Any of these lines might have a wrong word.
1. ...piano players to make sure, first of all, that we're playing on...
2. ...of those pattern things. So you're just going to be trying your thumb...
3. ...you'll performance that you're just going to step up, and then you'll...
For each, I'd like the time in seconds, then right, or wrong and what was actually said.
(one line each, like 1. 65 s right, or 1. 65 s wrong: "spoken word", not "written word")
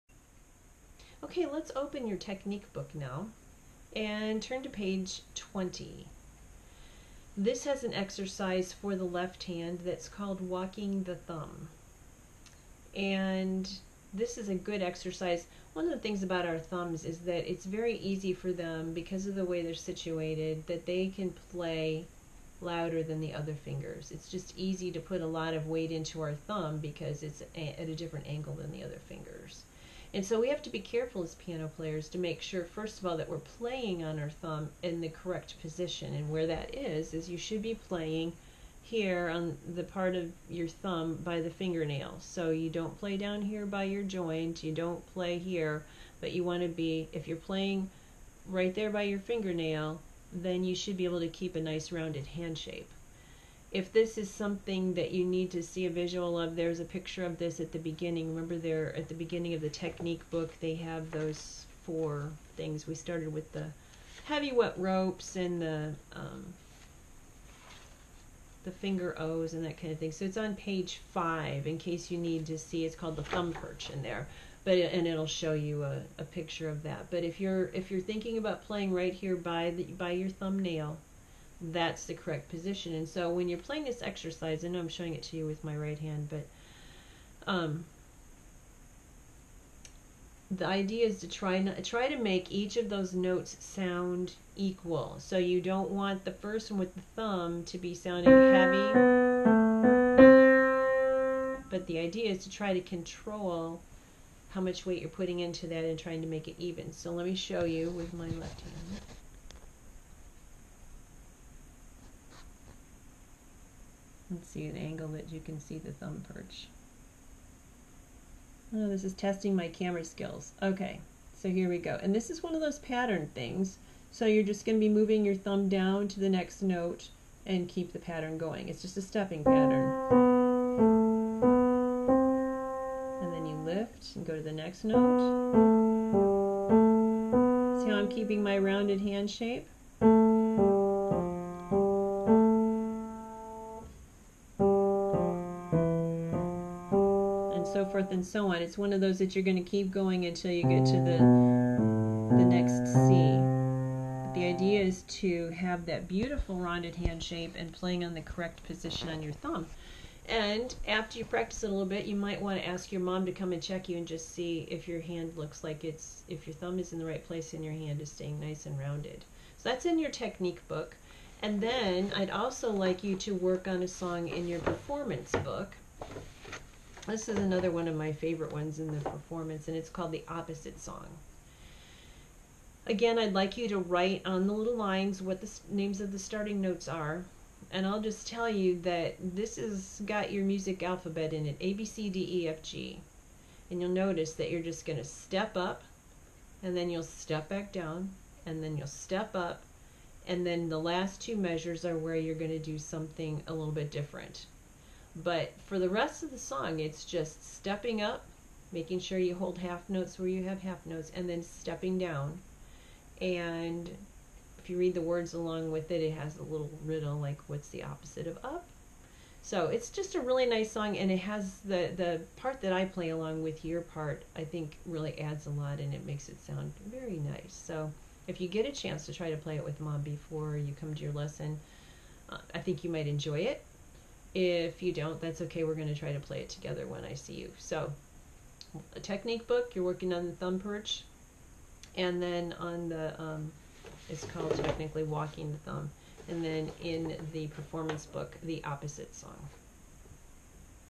1. 31 s right
2. 122 s wrong: "moving", not "trying"
3. 193 s wrong: "notice", not "performance".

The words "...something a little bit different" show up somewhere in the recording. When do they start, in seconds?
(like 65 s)
202 s.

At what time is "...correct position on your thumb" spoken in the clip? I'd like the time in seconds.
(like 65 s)
158 s.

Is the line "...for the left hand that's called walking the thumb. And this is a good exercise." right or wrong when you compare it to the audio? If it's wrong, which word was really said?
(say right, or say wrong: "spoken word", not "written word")
right.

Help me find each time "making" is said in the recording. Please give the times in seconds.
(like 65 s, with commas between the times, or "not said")
208 s.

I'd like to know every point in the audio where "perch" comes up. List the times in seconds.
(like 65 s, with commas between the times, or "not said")
73 s, 116 s, 240 s.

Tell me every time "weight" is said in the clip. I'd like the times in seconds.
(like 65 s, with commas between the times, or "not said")
25 s, 104 s.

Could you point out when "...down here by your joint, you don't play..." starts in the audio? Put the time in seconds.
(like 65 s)
43 s.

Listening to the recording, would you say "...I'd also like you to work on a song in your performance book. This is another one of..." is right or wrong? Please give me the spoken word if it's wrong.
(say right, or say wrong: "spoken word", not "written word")
right.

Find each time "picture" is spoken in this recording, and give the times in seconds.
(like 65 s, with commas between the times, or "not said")
56 s, 76 s.